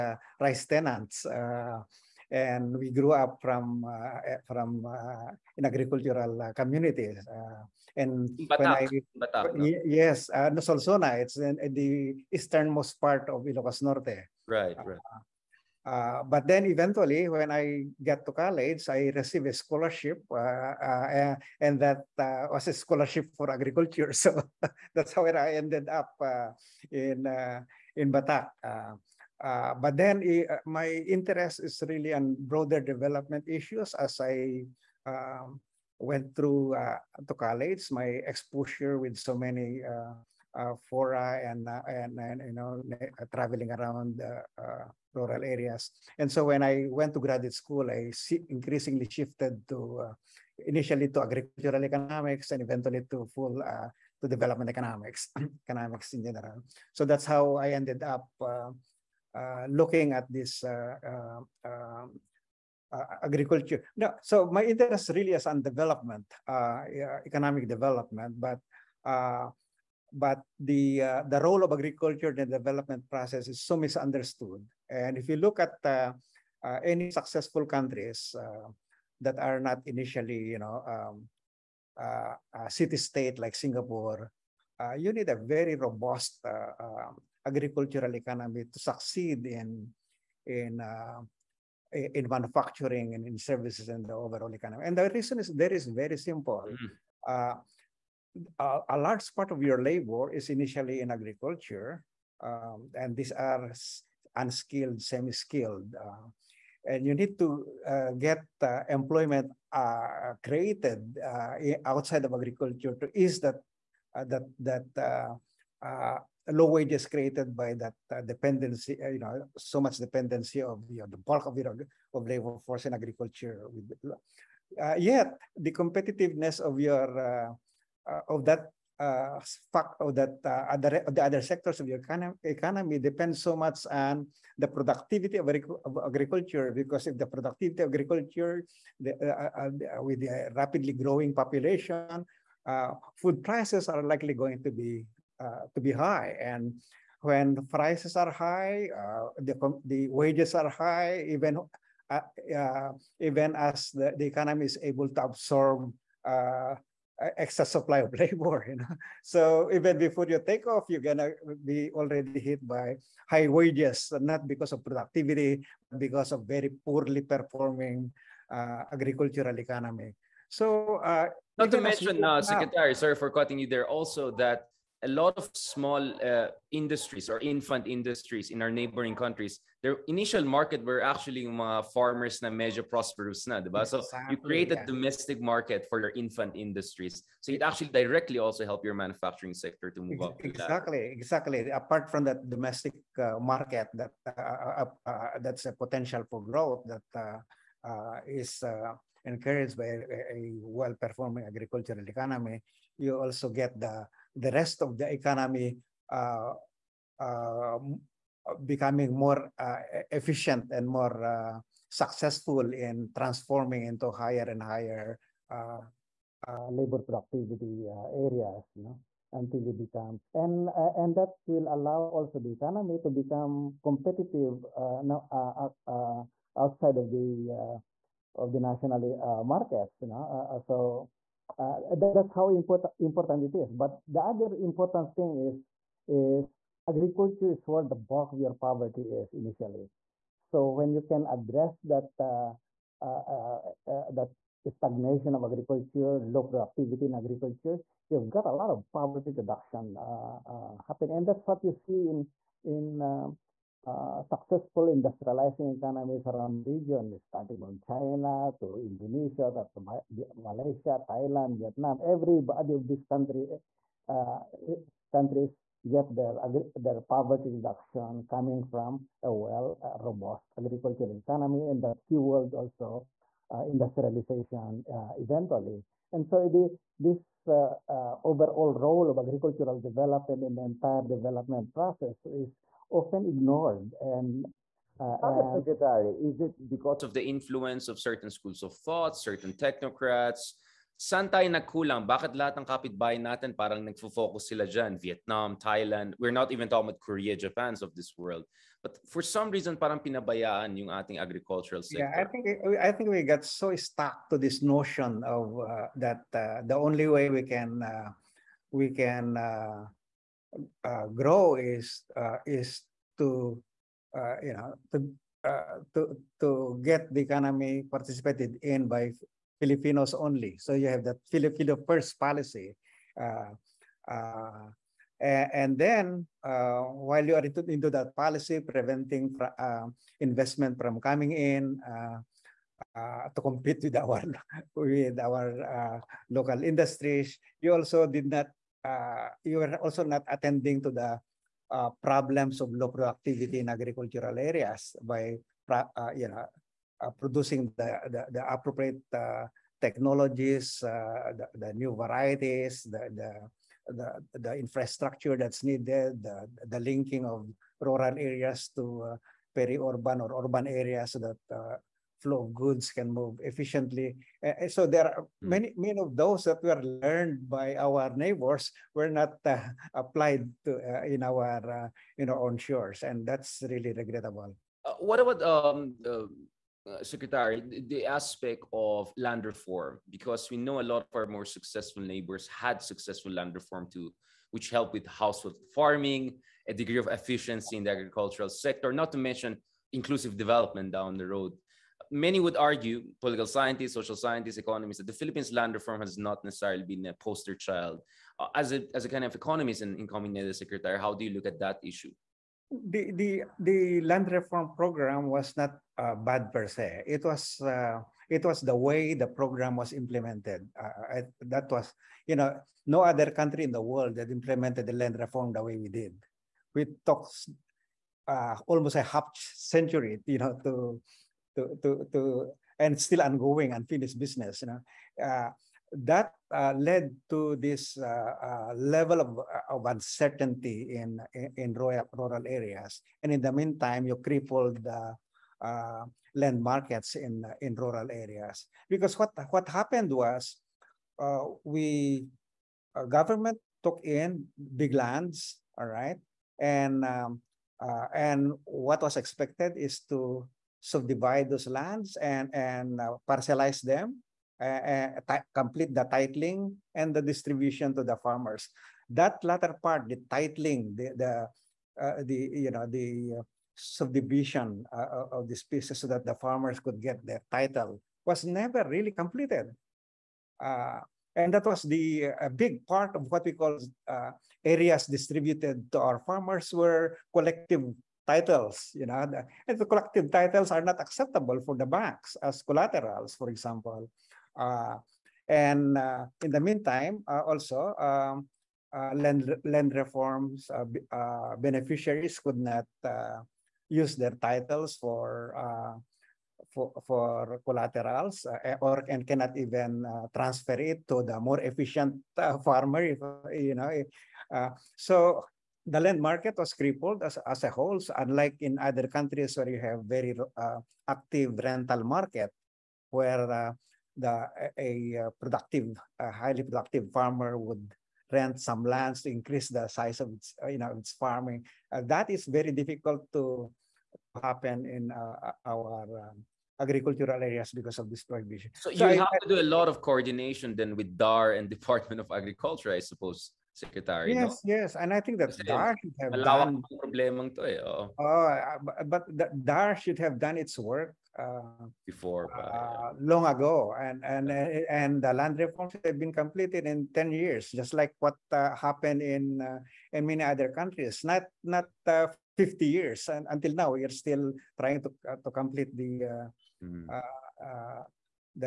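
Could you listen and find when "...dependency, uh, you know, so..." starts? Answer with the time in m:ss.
1:58.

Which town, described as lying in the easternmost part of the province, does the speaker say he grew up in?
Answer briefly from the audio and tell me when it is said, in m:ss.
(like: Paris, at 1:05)
Solsona, at 0:10.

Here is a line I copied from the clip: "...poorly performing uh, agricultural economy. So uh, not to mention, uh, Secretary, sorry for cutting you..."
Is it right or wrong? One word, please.
right.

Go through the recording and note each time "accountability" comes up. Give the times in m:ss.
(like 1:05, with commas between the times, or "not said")
not said.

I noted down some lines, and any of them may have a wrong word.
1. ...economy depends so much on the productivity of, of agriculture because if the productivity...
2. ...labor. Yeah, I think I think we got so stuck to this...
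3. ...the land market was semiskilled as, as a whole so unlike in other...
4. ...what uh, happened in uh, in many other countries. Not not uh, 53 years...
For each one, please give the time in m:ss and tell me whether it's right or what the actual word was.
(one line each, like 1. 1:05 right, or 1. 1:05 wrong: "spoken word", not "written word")
1. 2:12 right
2. 5:01 wrong: "sector", not "labor"
3. 8:25 wrong: "crippled", not "semiskilled"
4. 9:08 wrong: "50", not "53".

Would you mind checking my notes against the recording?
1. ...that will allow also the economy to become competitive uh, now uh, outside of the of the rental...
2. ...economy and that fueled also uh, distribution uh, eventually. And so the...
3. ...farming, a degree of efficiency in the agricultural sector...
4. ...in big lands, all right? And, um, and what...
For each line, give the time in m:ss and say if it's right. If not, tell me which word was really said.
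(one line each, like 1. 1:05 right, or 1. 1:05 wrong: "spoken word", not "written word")
1. 3:41 wrong: "national", not "rental"
2. 4:31 wrong: "industrialization", not "distribution"
3. 6:25 right
4. 7:24 right.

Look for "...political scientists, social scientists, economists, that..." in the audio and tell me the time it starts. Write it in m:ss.
6:33.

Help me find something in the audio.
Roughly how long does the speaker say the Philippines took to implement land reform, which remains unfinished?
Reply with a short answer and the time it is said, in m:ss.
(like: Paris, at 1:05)
Almost a half century, at 6:58.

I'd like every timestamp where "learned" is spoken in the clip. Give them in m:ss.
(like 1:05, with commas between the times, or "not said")
6:06.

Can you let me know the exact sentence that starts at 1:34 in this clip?
And the reason is there is very simple.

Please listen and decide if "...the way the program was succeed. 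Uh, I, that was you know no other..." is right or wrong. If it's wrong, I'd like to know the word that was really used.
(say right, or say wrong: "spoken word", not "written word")
wrong: "implemented", not "succeed".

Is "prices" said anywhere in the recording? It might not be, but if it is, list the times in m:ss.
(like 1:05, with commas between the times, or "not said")
2:23, 2:27.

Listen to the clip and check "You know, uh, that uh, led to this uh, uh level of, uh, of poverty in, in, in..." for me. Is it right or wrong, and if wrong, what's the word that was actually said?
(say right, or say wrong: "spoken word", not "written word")
wrong: "uncertainty", not "poverty".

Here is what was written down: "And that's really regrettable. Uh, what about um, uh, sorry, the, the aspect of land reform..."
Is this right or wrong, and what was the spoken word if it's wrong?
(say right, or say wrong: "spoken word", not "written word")
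wrong: "secretary", not "sorry".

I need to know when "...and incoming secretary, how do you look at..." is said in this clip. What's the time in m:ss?
6:39.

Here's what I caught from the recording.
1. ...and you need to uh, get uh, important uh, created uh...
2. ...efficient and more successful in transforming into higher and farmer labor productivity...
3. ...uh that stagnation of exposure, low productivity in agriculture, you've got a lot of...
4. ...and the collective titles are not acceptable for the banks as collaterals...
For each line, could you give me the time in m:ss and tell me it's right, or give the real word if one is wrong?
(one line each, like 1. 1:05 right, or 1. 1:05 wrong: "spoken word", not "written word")
1. 1:46 wrong: "employment", not "important"
2. 3:30 wrong: "higher", not "farmer"
3. 4:03 wrong: "agriculture", not "exposure"
4. 7:59 right.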